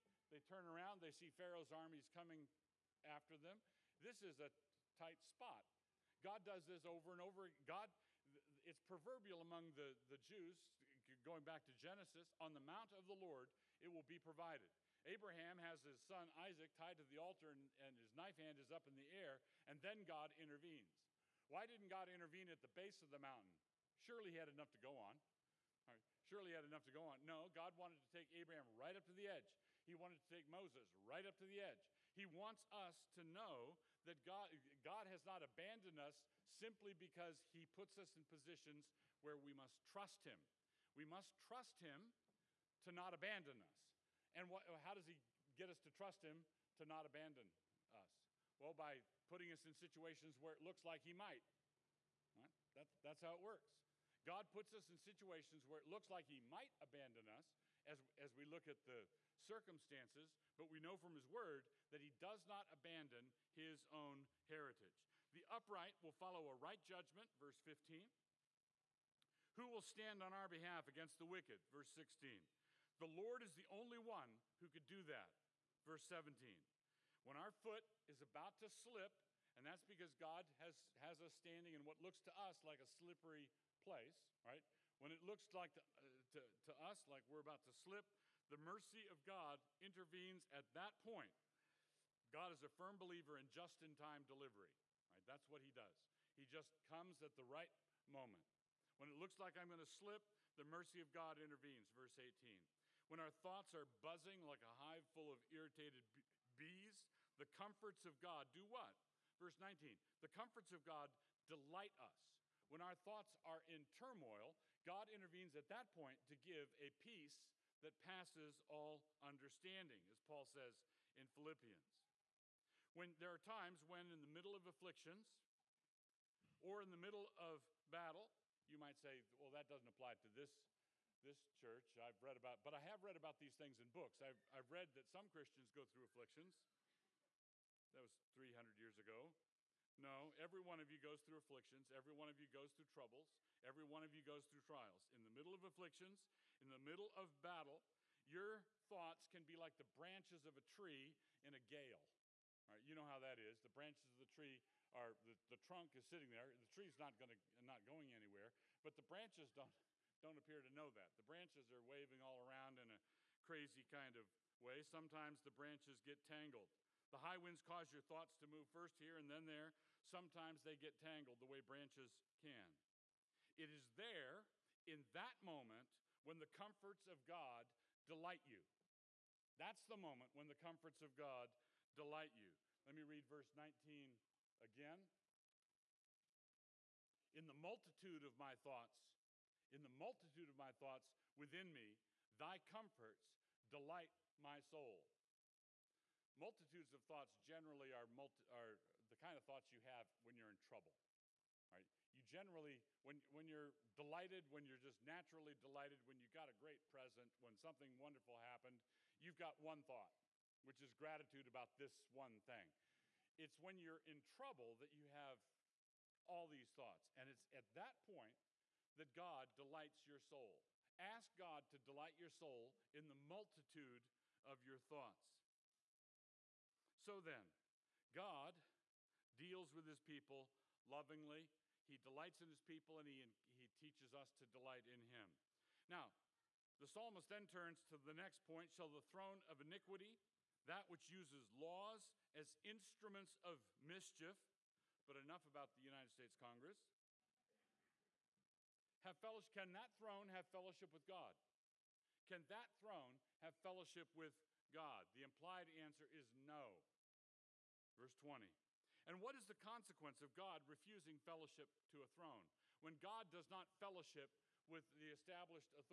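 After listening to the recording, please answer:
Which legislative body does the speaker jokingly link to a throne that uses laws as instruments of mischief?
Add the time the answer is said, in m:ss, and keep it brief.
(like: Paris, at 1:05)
United States Congress, at 4:05.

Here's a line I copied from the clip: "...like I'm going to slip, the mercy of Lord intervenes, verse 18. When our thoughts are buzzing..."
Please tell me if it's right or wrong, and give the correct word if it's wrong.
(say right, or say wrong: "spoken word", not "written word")
wrong: "God", not "Lord".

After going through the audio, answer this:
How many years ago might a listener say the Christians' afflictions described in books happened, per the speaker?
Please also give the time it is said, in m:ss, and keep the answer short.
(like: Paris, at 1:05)
300, at 2:18.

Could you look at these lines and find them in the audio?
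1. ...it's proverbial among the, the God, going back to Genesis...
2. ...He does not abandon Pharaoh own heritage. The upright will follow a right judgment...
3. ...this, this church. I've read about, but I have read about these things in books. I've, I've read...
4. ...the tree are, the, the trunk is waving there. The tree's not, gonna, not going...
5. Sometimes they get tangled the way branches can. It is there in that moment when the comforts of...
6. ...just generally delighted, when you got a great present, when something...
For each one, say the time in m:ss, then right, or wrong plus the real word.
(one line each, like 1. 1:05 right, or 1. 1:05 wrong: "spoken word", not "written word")
1. 0:08 wrong: "Jews", not "God"
2. 1:01 wrong: "His", not "Pharaoh"
3. 2:10 right
4. 2:34 wrong: "sitting", not "waving"
5. 2:50 right
6. 3:24 wrong: "naturally", not "generally".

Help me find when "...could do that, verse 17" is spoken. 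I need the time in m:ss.
1:14.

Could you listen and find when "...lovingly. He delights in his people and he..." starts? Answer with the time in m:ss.
3:50.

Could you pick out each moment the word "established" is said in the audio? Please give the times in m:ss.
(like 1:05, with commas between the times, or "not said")
4:25.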